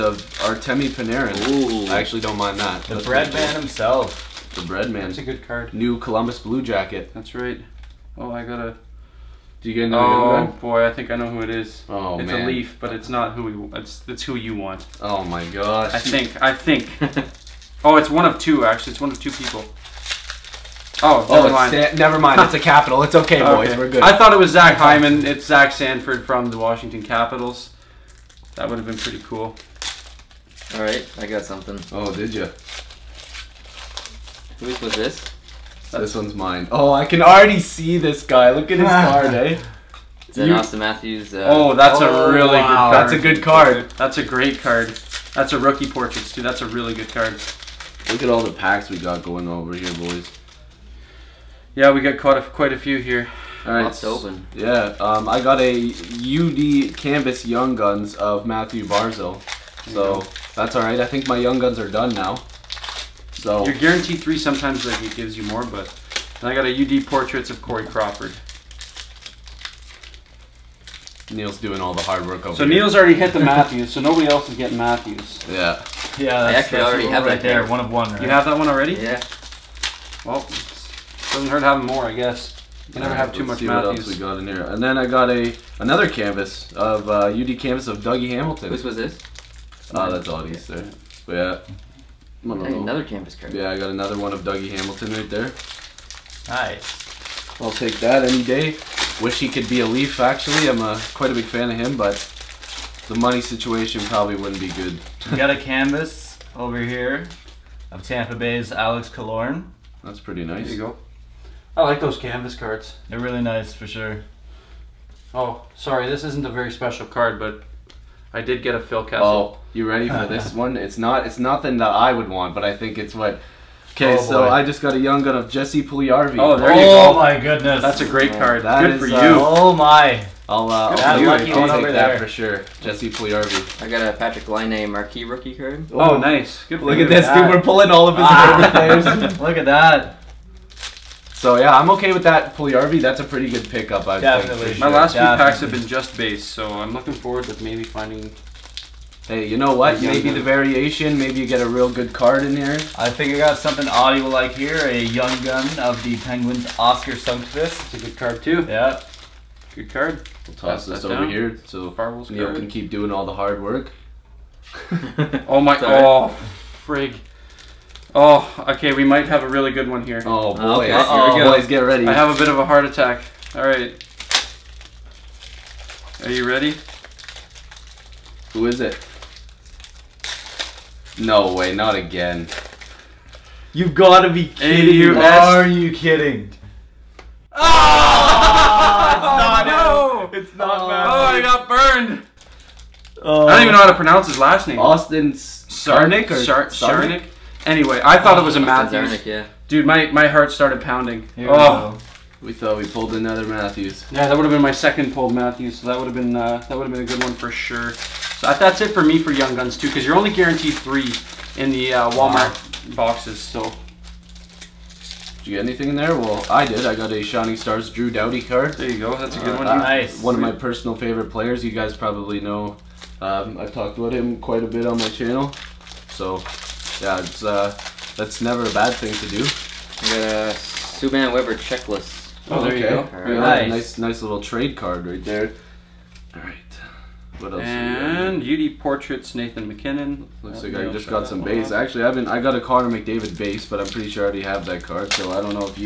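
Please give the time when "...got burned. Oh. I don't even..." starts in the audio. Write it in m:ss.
3:11.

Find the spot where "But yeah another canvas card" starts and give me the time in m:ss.
1:31.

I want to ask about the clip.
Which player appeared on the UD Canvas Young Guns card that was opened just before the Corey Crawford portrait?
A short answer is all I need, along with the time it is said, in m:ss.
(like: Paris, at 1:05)
Mathew Barzal, at 0:58.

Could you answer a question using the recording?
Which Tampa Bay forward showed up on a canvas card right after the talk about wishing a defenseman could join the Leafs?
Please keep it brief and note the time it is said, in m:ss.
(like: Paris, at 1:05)
Alex Killorn, at 1:48.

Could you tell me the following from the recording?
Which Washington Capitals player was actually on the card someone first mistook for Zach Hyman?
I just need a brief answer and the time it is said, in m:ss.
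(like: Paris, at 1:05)
Zach Sanford, at 0:25.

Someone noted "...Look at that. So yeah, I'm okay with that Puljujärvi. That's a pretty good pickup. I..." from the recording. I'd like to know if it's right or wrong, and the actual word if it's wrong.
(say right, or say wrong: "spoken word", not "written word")
right.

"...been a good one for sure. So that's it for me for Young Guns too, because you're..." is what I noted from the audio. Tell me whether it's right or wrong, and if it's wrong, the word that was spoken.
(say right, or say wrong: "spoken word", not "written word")
right.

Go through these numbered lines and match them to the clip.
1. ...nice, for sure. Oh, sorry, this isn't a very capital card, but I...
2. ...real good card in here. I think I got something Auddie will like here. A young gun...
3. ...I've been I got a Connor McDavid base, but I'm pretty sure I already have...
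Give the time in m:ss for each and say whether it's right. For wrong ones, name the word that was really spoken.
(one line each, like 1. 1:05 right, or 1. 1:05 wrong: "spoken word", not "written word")
1. 1:53 wrong: "special", not "capital"
2. 2:31 right
3. 4:02 right.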